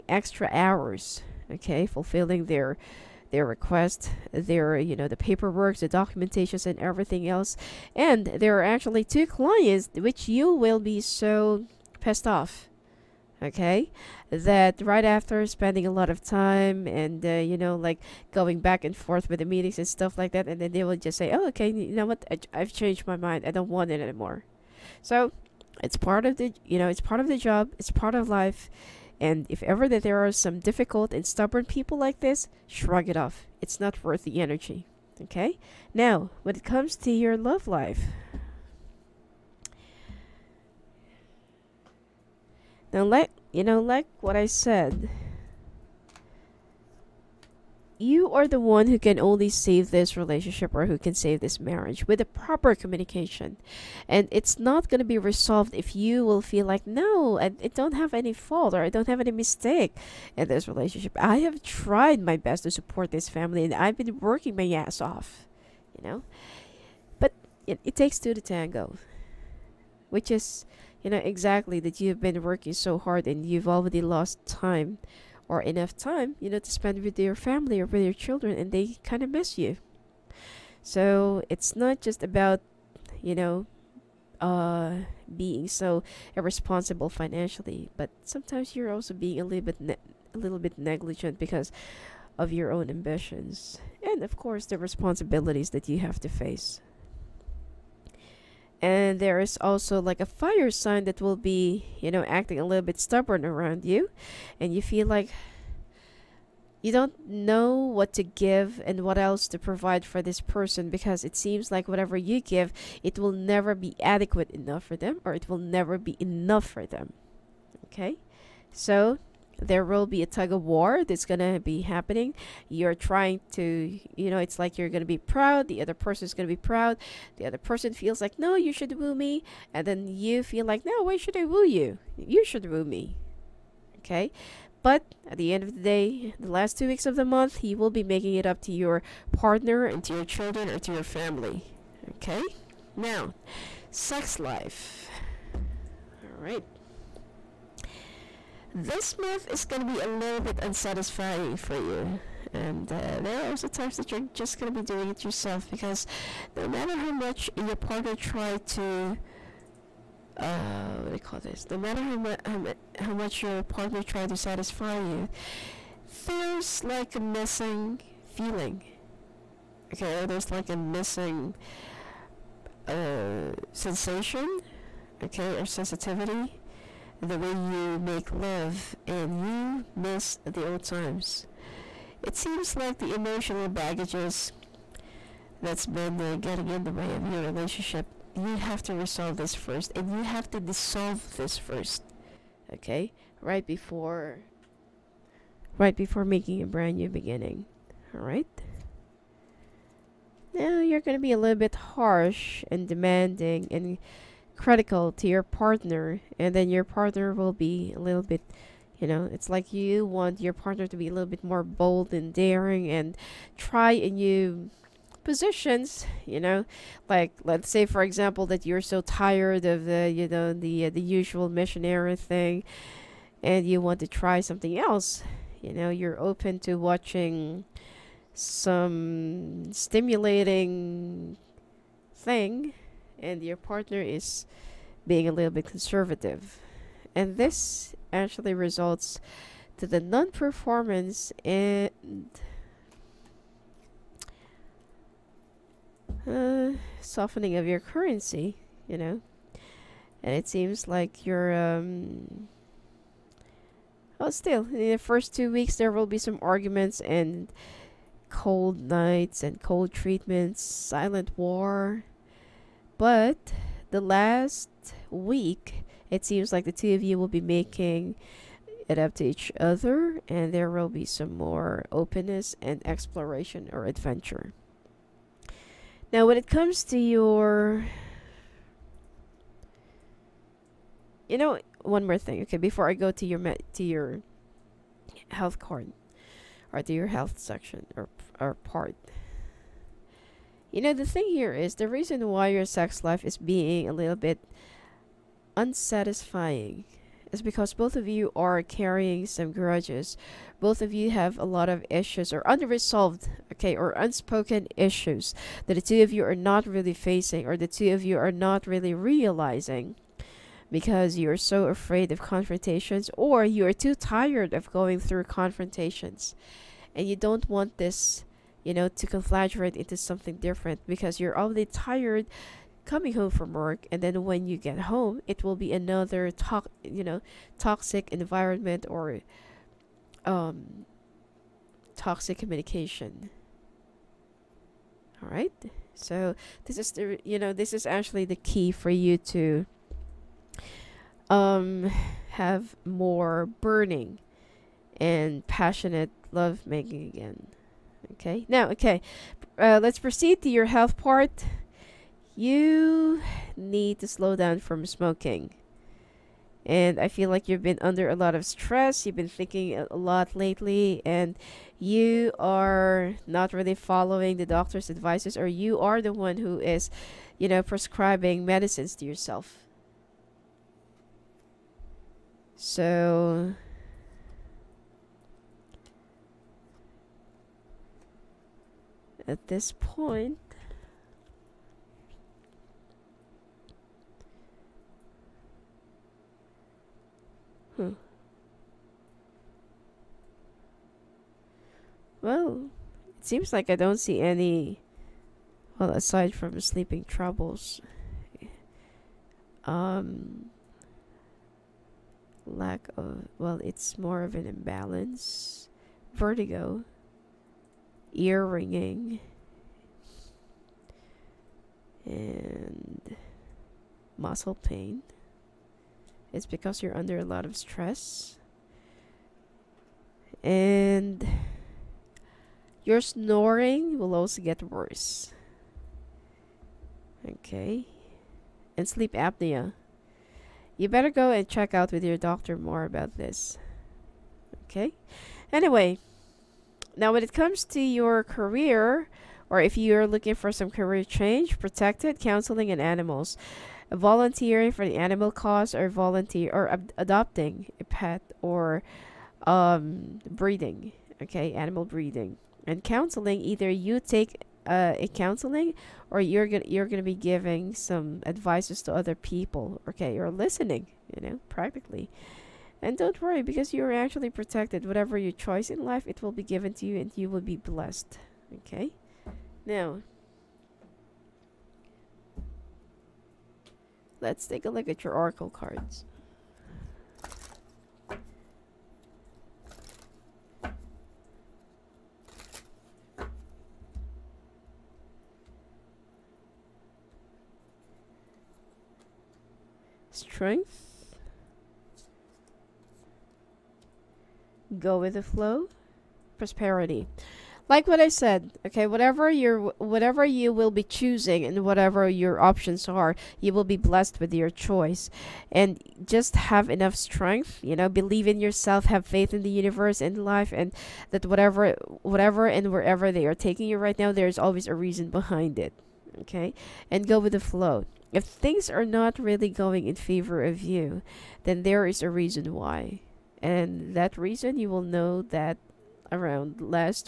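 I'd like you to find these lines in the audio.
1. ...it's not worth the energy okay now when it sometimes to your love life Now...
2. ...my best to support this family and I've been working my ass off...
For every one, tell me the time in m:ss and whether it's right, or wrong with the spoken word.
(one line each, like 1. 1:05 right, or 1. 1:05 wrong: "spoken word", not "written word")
1. 0:33 wrong: "comes", not "sometimes"
2. 1:02 right.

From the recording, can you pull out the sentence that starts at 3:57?
And this actually results to the non-performance and uh, softening of your currency, you know.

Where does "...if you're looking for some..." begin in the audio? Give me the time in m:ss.
7:19.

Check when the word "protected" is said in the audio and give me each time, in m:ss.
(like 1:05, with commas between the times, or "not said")
7:21, 7:44.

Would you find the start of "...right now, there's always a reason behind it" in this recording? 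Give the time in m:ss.
8:33.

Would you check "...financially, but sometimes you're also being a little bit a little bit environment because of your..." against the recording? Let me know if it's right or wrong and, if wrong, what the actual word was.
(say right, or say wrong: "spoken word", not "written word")
wrong: "negligent", not "environment".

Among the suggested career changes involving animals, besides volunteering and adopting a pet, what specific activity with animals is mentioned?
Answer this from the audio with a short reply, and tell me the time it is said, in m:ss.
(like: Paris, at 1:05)
Animal breeding, at 7:31.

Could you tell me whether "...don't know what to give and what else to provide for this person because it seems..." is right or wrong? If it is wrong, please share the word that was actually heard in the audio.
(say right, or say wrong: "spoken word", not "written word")
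right.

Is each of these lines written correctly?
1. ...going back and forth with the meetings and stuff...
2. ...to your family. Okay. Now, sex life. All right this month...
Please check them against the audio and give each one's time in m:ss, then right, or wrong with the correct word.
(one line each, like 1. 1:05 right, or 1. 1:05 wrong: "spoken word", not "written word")
1. 0:18 right
2. 2:20 right.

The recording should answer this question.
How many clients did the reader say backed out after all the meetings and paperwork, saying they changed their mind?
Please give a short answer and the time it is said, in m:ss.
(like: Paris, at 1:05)
2, at 0:09.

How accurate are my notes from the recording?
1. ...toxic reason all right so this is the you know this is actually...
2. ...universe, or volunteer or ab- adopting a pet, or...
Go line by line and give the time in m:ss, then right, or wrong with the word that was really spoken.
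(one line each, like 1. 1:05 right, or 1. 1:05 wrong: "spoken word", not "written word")
1. 5:31 wrong: "communication", not "reason"
2. 7:25 wrong: "cause", not "universe".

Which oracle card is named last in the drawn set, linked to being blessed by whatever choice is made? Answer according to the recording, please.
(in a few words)
Prosperity.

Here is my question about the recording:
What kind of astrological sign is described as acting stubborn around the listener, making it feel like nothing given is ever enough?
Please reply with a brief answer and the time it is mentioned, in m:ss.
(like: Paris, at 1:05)
Fire sign, at 1:40.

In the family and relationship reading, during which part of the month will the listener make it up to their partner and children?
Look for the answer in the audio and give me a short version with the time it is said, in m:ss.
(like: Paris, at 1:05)
Last two weeks, at 2:16.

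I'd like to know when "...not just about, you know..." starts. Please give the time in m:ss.
1:21.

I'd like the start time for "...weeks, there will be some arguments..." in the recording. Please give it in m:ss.
4:15.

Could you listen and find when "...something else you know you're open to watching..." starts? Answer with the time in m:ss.
3:44.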